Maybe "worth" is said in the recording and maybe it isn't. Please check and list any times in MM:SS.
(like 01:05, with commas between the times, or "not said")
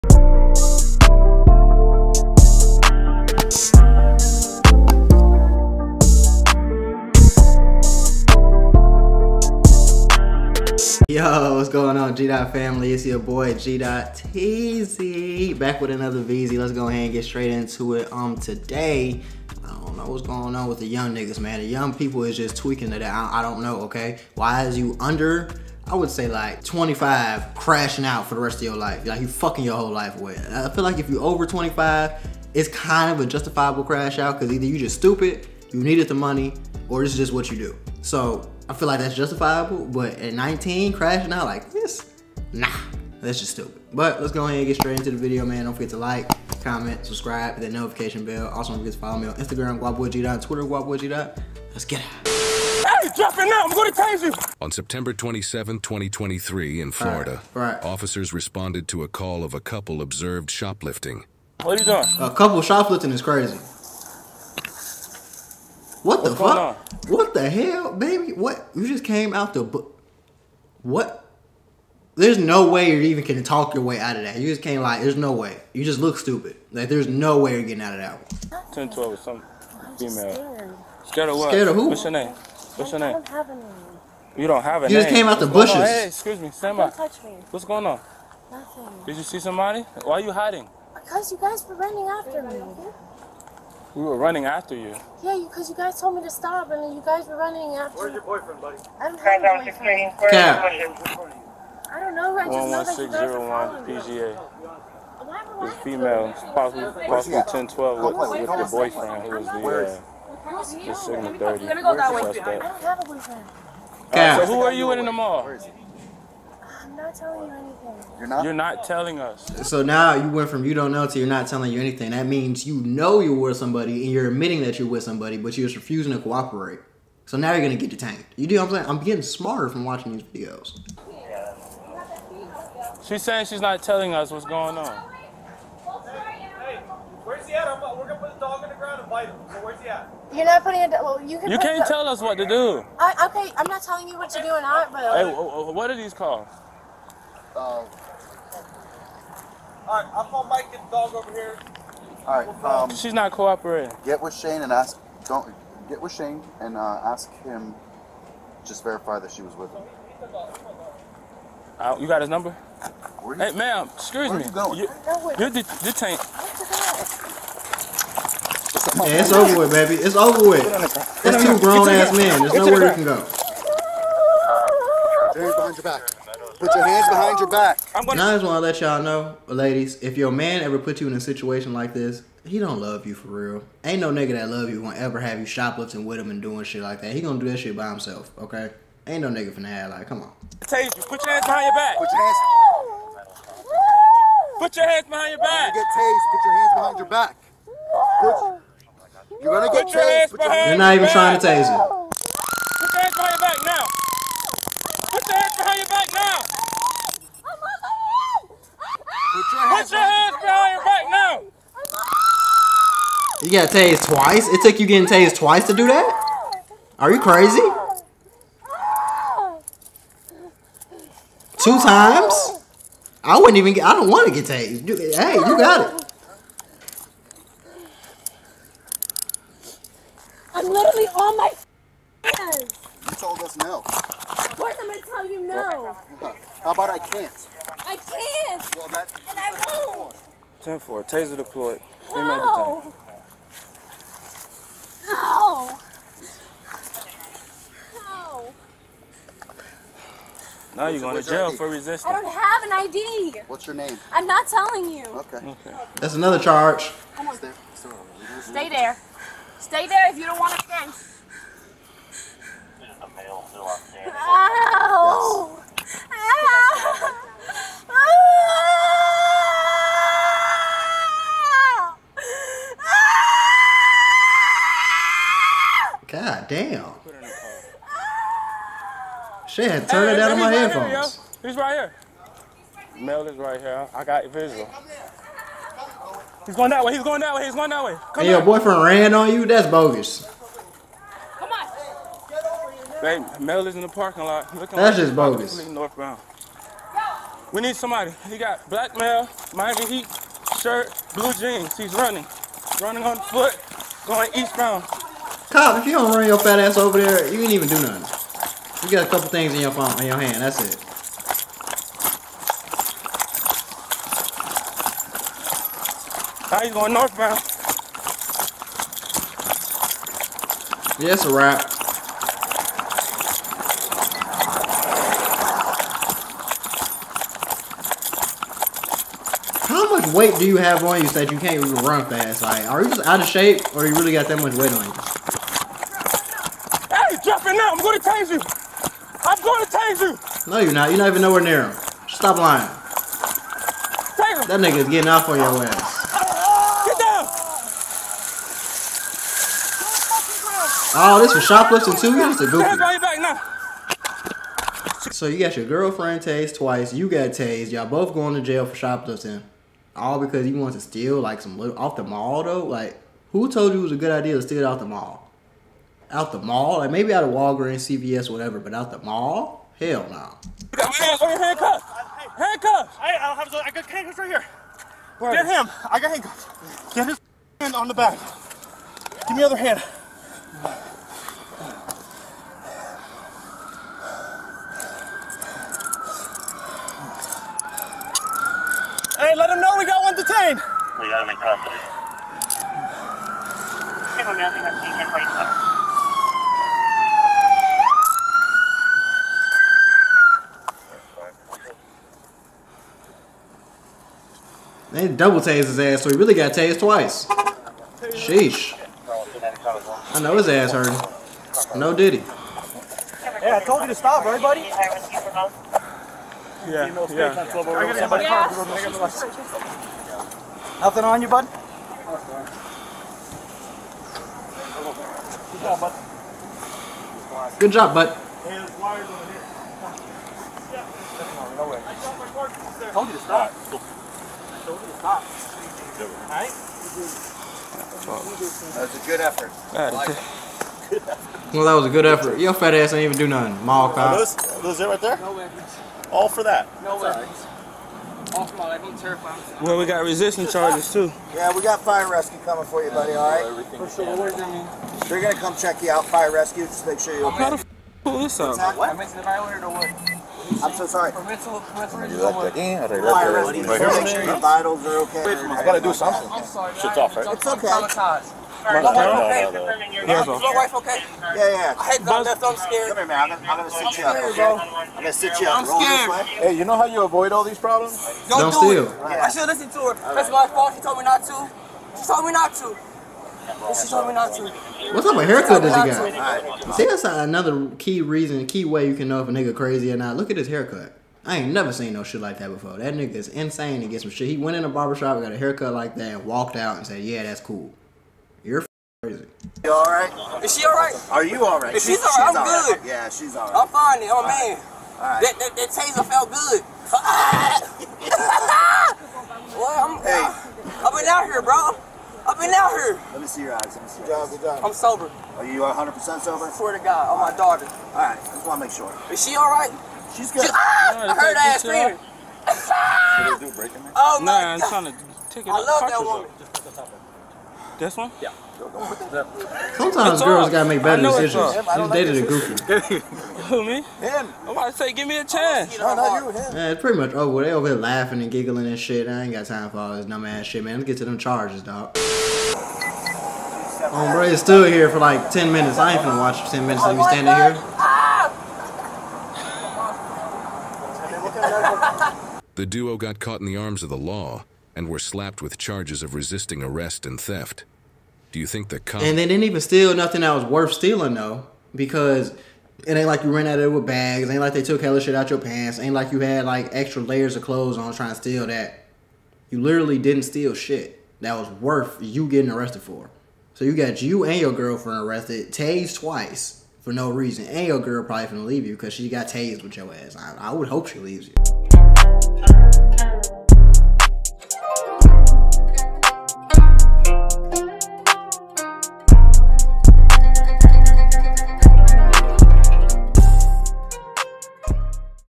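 09:20, 09:31.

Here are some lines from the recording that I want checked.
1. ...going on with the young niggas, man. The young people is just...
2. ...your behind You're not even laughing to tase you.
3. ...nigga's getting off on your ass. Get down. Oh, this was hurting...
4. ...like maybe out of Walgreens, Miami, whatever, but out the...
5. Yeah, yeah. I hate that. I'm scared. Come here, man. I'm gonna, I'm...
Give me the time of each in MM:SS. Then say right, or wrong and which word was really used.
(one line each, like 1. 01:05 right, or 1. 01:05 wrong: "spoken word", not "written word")
1. 00:20 right
2. 03:20 wrong: "trying", not "laughing"
3. 05:44 wrong: "shoplifting", not "hurting"
4. 06:06 wrong: "CVS", not "Miami"
5. 07:51 right.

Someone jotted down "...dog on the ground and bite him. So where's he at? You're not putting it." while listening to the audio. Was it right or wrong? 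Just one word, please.
right.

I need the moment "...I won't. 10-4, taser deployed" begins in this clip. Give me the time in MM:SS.
03:59.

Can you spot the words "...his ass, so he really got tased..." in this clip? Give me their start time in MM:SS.
06:45.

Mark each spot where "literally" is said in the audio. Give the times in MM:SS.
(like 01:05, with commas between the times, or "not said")
03:50, 09:29.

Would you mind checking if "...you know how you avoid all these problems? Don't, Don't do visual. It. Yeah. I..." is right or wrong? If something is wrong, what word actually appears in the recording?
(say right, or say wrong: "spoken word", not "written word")
wrong: "steal", not "visual".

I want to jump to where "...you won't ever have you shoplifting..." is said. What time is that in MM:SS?
03:04.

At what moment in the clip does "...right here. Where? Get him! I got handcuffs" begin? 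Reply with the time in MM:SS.
06:14.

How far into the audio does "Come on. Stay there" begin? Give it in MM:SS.
04:17.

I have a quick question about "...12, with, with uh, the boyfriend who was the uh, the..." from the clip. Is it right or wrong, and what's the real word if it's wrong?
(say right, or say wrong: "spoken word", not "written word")
right.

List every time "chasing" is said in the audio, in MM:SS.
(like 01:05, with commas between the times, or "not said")
not said.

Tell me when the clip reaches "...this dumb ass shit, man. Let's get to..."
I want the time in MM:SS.
08:59.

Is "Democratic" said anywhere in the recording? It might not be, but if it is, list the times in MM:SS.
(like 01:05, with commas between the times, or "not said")
not said.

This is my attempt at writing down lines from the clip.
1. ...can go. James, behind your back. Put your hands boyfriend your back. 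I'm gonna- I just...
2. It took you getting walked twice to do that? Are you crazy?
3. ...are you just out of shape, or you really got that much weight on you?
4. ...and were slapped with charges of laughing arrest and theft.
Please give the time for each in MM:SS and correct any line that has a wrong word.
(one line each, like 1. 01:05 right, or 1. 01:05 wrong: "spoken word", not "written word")
1. 02:52 wrong: "behind", not "boyfriend"
2. 03:34 wrong: "tased", not "walked"
3. 05:32 right
4. 09:14 wrong: "resisting", not "laughing".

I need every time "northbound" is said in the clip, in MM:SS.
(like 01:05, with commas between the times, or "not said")
04:55, 05:16.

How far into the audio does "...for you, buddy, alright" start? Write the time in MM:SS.
07:32.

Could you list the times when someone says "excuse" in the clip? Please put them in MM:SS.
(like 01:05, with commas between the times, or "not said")
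01:26, 02:43.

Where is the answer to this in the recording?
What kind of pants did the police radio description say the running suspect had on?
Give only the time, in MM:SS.
05:01.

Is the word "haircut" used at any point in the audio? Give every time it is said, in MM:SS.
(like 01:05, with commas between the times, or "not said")
08:05, 08:10, 08:15.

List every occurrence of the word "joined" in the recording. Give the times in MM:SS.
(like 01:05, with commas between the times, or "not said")
not said.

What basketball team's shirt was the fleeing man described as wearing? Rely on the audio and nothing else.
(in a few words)
Miami Heat.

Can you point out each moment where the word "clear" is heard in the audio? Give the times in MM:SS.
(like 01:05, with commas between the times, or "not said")
not said.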